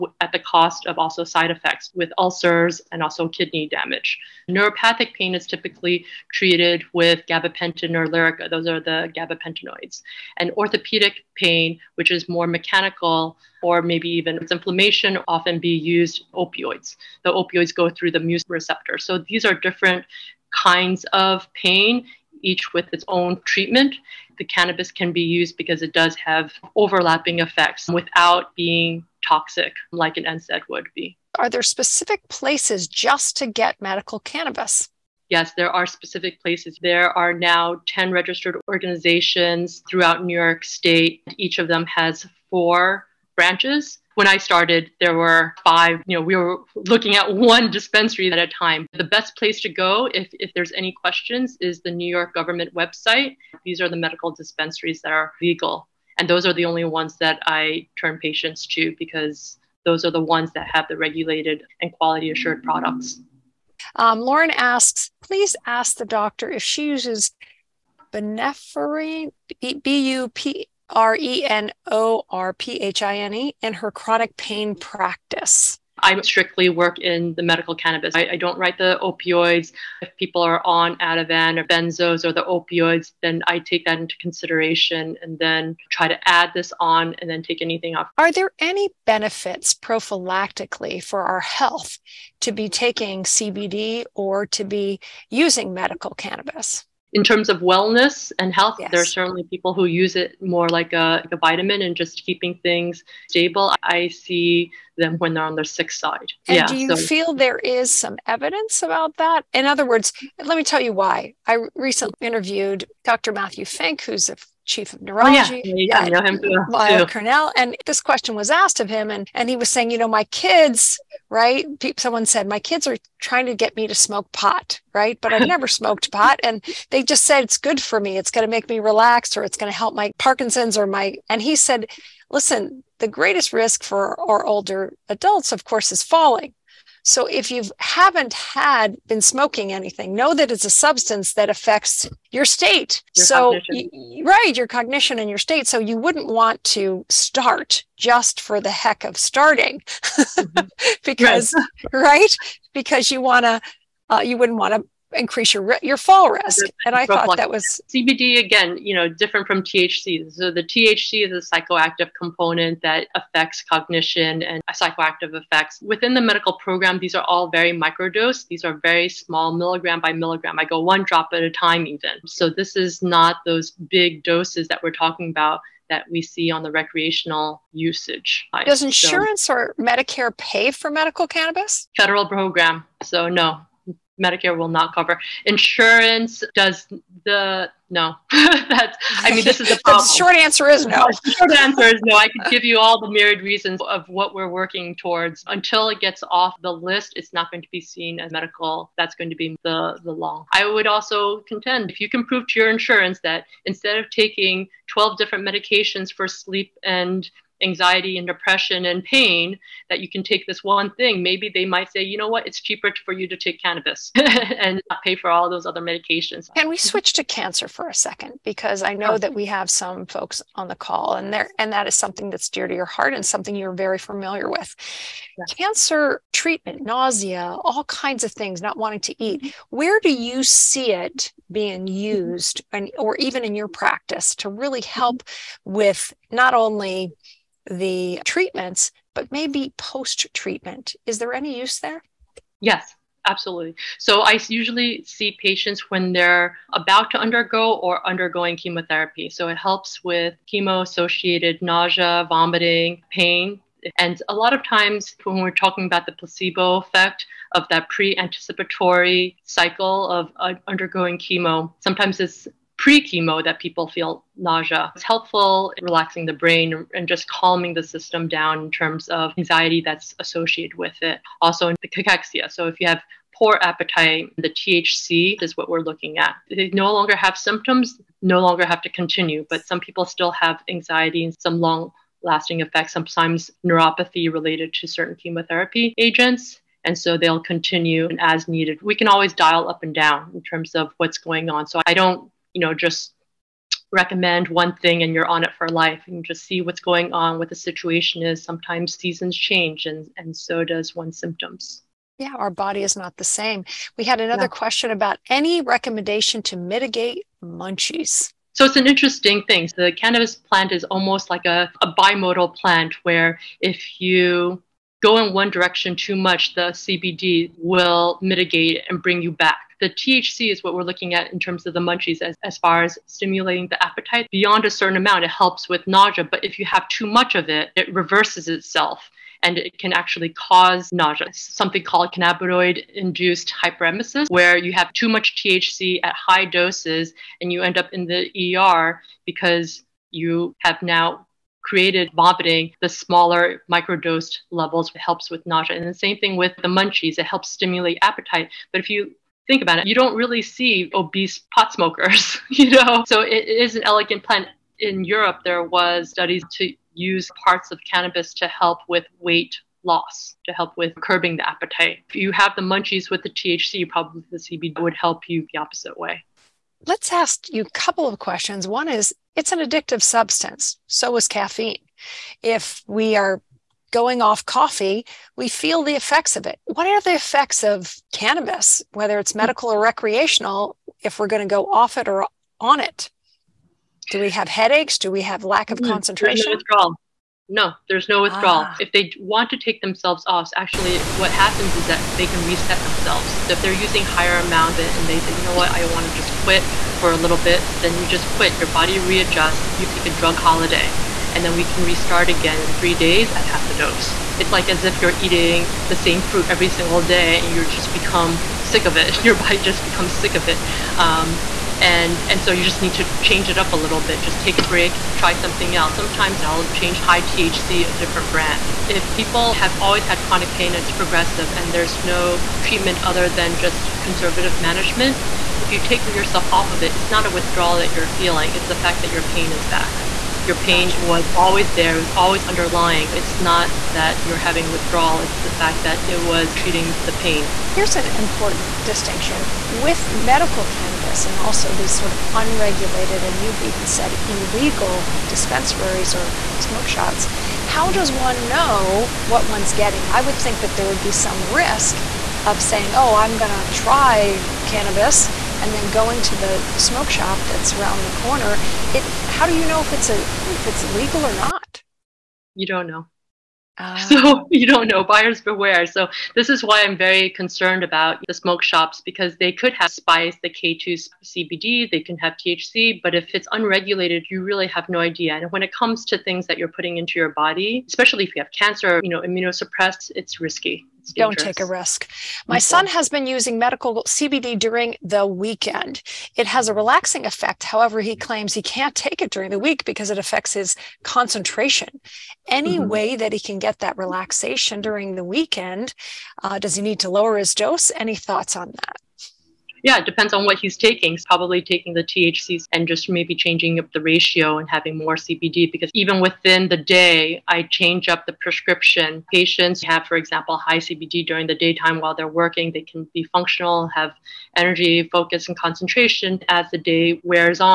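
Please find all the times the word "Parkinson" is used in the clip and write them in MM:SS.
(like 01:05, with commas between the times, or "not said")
02:10.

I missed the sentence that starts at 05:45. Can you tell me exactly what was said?
And the same thing with the munchies, it helps stimulate appetite.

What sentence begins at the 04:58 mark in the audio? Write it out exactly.
Sometimes seasons change and, and so does one's symptoms.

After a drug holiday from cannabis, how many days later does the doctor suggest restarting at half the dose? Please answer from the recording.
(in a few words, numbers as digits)
3.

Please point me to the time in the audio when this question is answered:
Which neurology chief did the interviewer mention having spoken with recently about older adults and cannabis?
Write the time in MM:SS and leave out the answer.
01:53.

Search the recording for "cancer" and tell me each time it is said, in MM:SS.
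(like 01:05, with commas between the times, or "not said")
03:37, 03:45, 07:58.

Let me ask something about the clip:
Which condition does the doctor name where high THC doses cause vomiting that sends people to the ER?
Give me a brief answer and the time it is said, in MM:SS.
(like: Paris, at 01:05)
cannabinoid induced hyperemesis, at 05:32.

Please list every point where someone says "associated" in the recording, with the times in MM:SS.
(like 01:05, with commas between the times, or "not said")
04:10, 04:30.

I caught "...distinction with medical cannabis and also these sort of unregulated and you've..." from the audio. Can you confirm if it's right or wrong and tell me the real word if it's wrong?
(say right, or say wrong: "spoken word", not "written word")
right.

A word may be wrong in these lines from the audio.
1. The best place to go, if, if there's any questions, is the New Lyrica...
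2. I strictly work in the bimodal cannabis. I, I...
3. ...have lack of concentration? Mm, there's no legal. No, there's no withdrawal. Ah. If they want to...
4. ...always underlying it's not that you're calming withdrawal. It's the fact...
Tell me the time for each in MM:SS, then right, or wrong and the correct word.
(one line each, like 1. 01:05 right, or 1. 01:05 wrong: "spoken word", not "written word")
1. 00:48 wrong: "York", not "Lyrica"
2. 01:15 wrong: "medical", not "bimodal"
3. 06:25 wrong: "withdrawal", not "legal"
4. 07:12 wrong: "having", not "calming".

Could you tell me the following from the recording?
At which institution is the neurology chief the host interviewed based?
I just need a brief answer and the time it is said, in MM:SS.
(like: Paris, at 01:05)
Weill Cornell, at 01:56.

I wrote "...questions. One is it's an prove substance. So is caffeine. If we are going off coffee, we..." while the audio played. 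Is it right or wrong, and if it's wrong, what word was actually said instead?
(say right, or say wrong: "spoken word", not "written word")
wrong: "addictive", not "prove".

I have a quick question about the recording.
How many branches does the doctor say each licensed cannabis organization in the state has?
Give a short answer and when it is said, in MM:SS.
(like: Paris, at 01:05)
4, at 00:42.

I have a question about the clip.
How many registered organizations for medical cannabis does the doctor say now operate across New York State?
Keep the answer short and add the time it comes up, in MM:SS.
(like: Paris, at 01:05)
10, at 00:37.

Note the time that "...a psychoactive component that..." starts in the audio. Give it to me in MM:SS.
02:41.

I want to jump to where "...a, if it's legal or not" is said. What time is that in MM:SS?
07:40.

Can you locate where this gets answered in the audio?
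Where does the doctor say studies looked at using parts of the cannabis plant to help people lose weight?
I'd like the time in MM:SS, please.
05:55.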